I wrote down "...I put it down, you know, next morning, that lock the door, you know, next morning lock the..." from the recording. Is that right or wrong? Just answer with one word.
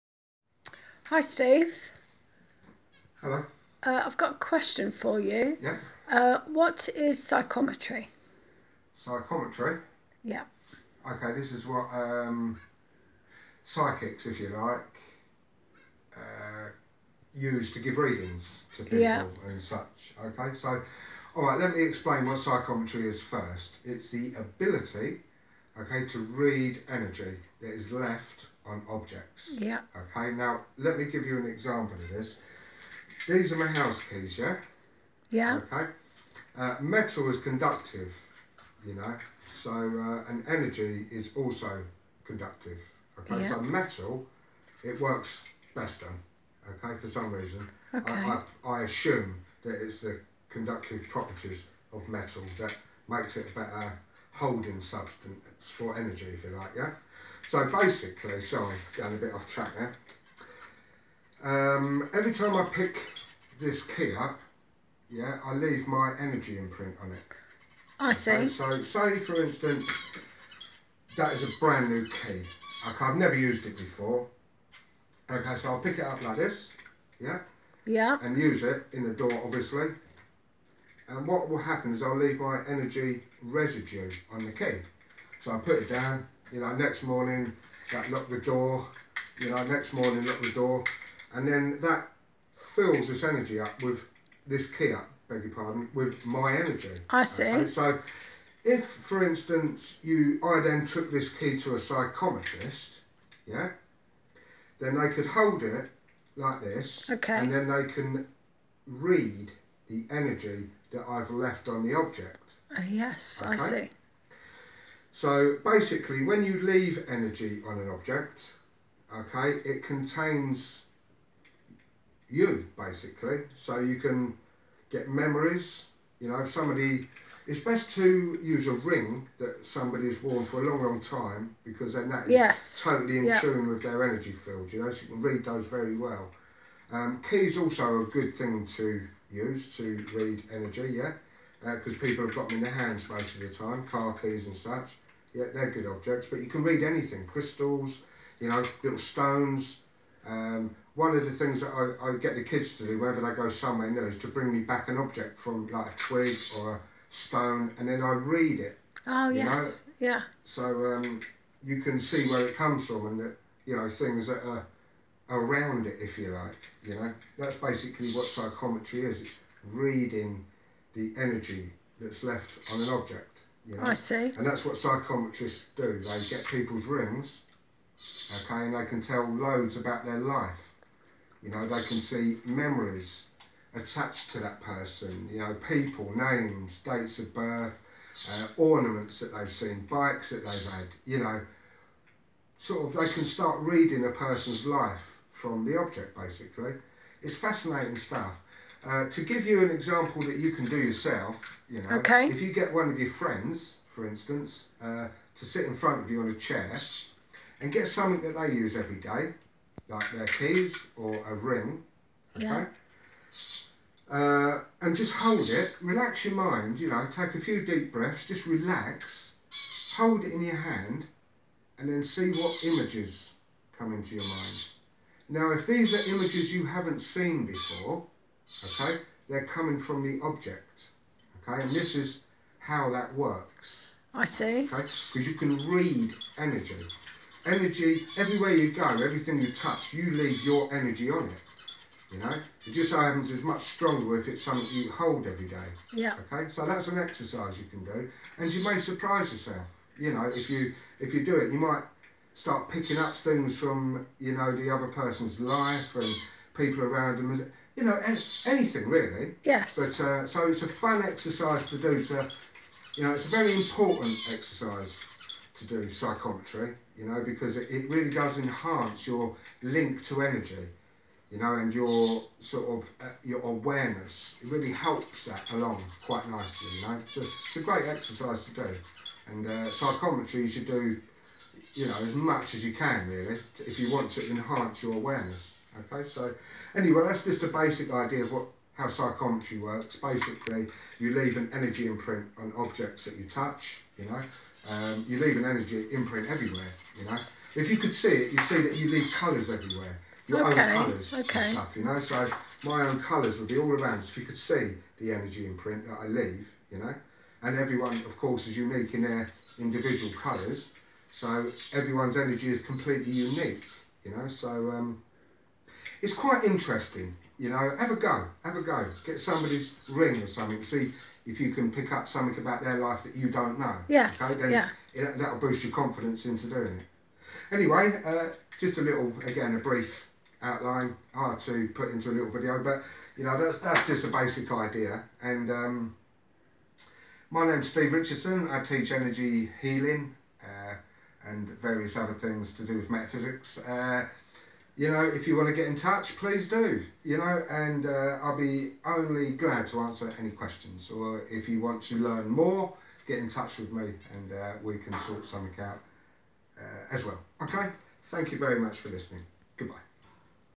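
right.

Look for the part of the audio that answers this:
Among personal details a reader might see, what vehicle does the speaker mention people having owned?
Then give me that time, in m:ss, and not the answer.
3:09.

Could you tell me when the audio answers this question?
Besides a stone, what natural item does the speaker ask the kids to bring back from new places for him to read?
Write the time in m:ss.
2:35.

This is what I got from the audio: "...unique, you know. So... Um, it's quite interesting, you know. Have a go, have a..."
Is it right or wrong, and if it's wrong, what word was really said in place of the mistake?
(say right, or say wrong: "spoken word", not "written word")
right.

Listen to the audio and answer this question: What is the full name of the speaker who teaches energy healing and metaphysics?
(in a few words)
Steve Richardson.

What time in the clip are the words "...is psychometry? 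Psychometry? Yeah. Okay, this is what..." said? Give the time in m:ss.
0:06.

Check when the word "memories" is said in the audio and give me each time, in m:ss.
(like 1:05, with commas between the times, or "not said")
2:05, 3:02.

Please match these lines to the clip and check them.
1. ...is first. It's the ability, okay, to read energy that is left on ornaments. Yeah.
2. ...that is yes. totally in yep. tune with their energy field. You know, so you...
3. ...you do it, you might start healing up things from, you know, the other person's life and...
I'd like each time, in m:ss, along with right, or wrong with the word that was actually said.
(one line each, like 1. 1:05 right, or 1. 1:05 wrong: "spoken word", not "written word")
1. 0:23 wrong: "objects", not "ornaments"
2. 2:12 right
3. 4:11 wrong: "picking", not "healing".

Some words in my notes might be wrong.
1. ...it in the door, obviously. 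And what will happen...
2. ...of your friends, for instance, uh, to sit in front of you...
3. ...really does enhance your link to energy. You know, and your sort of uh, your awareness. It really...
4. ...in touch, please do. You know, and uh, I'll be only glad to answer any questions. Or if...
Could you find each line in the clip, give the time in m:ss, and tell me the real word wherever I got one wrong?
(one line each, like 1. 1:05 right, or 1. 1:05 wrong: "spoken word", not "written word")
1. 1:18 right
2. 3:22 right
3. 4:27 right
4. 5:45 right.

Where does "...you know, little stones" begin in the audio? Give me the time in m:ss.
2:28.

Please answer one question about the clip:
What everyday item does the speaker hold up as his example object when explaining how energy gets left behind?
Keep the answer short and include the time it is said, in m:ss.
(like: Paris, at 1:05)
House keys, at 0:33.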